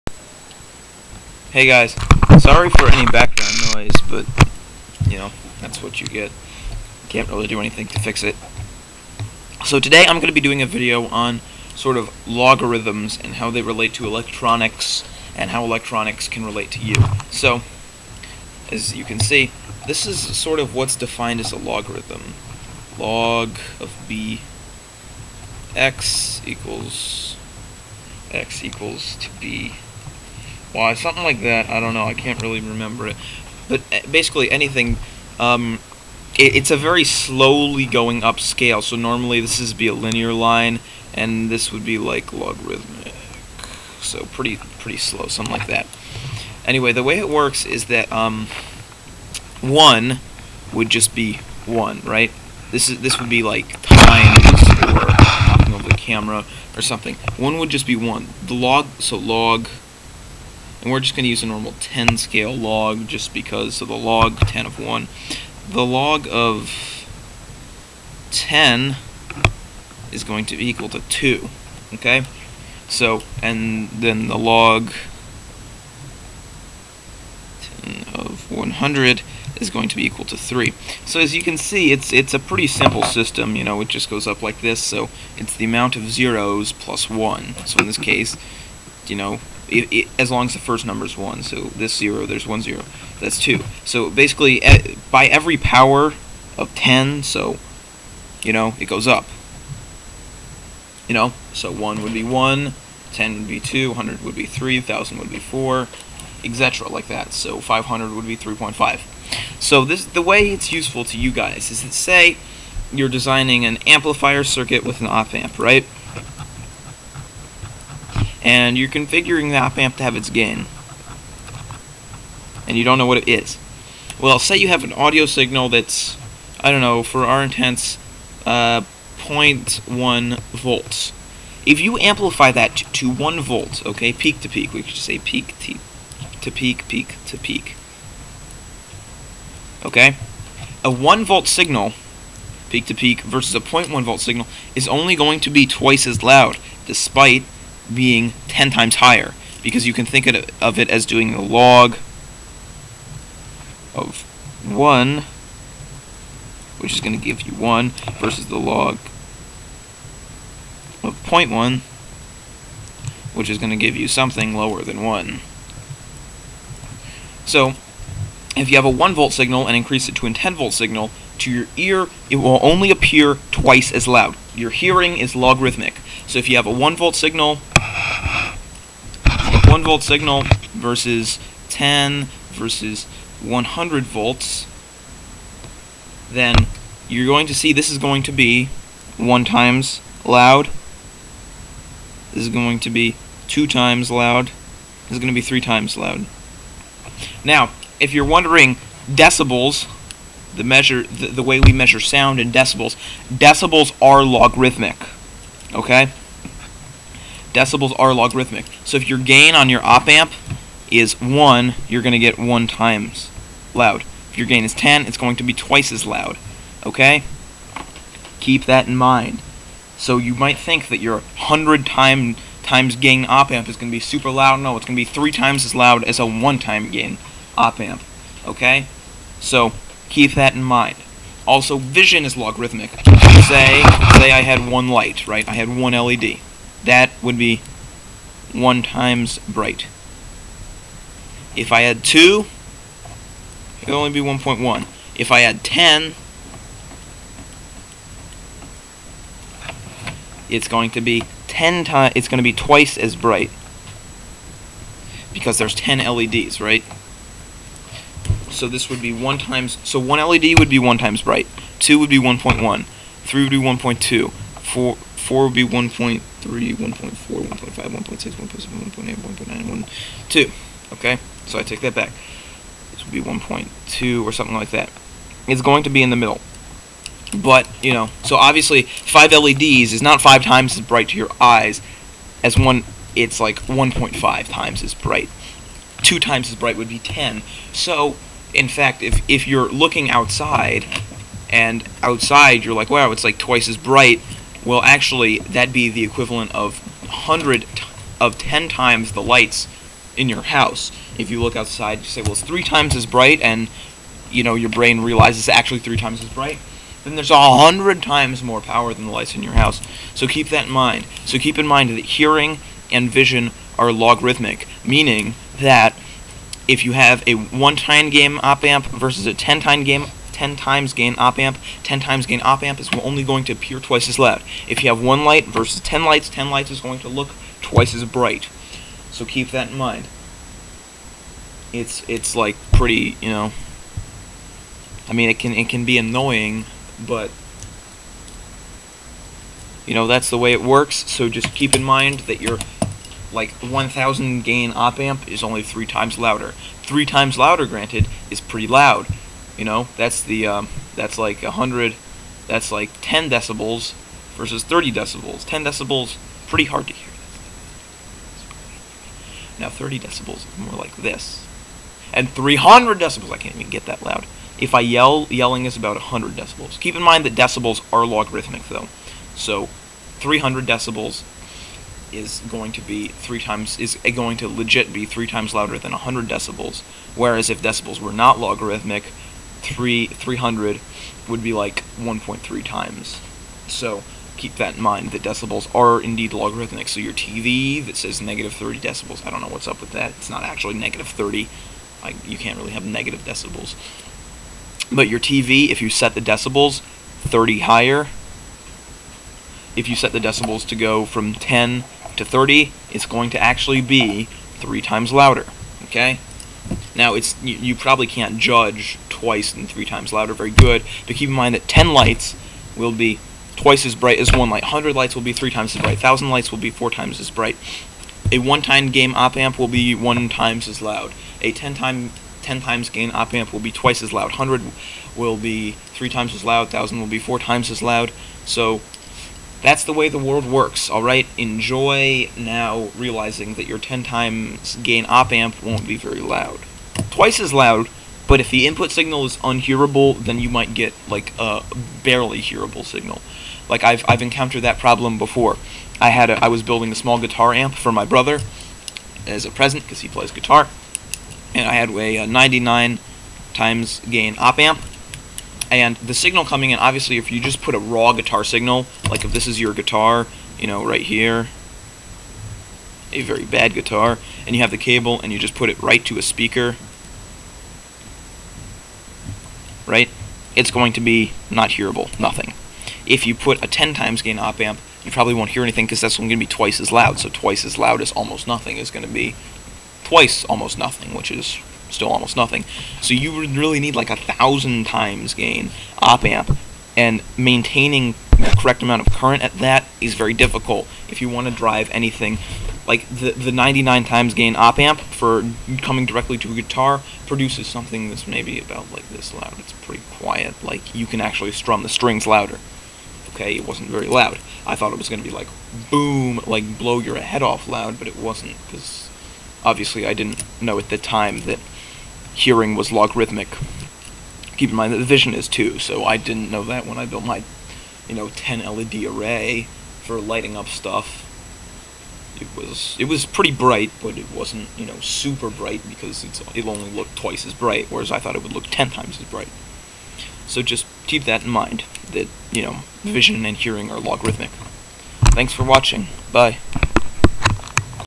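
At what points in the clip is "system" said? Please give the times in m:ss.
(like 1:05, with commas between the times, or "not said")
1:23.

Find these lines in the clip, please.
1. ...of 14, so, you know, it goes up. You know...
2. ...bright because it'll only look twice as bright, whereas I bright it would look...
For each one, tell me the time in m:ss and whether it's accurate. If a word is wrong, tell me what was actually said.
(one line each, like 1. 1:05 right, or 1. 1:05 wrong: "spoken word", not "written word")
1. 1:36 wrong: "10", not "14"
2. 8:45 wrong: "thought", not "bright".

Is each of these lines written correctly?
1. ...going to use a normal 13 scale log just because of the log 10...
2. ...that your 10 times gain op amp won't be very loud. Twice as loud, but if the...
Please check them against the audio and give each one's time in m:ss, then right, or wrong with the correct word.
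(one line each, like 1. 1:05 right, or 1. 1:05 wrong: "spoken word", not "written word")
1. 1:01 wrong: "10", not "13"
2. 7:13 right.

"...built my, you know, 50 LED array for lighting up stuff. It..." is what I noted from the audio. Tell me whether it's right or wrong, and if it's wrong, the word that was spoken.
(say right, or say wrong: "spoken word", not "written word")
wrong: "10", not "50".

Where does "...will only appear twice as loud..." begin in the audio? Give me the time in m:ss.
2:52.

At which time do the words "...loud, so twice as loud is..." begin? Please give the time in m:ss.
7:56.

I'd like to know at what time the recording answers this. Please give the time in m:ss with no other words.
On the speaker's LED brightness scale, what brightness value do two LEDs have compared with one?
4:01.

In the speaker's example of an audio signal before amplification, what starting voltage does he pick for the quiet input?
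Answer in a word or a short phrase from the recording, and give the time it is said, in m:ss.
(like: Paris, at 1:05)
0.1 volts, at 2:09.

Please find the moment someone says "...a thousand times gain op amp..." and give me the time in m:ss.
8:04.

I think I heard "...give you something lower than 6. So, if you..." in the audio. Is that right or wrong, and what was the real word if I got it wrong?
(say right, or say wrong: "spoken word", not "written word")
wrong: "1", not "6".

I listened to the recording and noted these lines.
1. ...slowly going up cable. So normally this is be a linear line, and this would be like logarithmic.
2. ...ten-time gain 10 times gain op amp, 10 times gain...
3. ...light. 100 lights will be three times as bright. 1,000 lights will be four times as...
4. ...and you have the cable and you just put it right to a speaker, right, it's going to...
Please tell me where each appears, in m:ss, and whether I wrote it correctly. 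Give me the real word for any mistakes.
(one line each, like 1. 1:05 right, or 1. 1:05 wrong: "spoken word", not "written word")
1. 0:37 wrong: "scale", not "cable"
2. 5:19 right
3. 6:54 right
4. 7:44 right.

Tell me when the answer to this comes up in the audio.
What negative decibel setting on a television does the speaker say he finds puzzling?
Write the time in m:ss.
6:28.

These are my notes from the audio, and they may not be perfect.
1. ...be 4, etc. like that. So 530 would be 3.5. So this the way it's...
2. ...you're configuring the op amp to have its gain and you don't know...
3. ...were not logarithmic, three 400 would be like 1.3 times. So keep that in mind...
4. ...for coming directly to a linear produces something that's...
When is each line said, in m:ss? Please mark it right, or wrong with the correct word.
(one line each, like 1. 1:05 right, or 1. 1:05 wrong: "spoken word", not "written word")
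1. 1:45 wrong: "500", not "530"
2. 1:58 right
3. 6:17 wrong: "300", not "400"
4. 8:14 wrong: "guitar", not "linear".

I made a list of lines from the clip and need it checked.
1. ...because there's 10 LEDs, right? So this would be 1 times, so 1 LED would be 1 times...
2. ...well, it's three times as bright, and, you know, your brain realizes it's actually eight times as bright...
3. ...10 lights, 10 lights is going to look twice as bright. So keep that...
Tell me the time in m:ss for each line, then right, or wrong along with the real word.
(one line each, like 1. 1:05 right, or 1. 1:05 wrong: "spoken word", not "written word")
1. 4:15 right
2. 5:02 wrong: "three", not "eight"
3. 5:25 right.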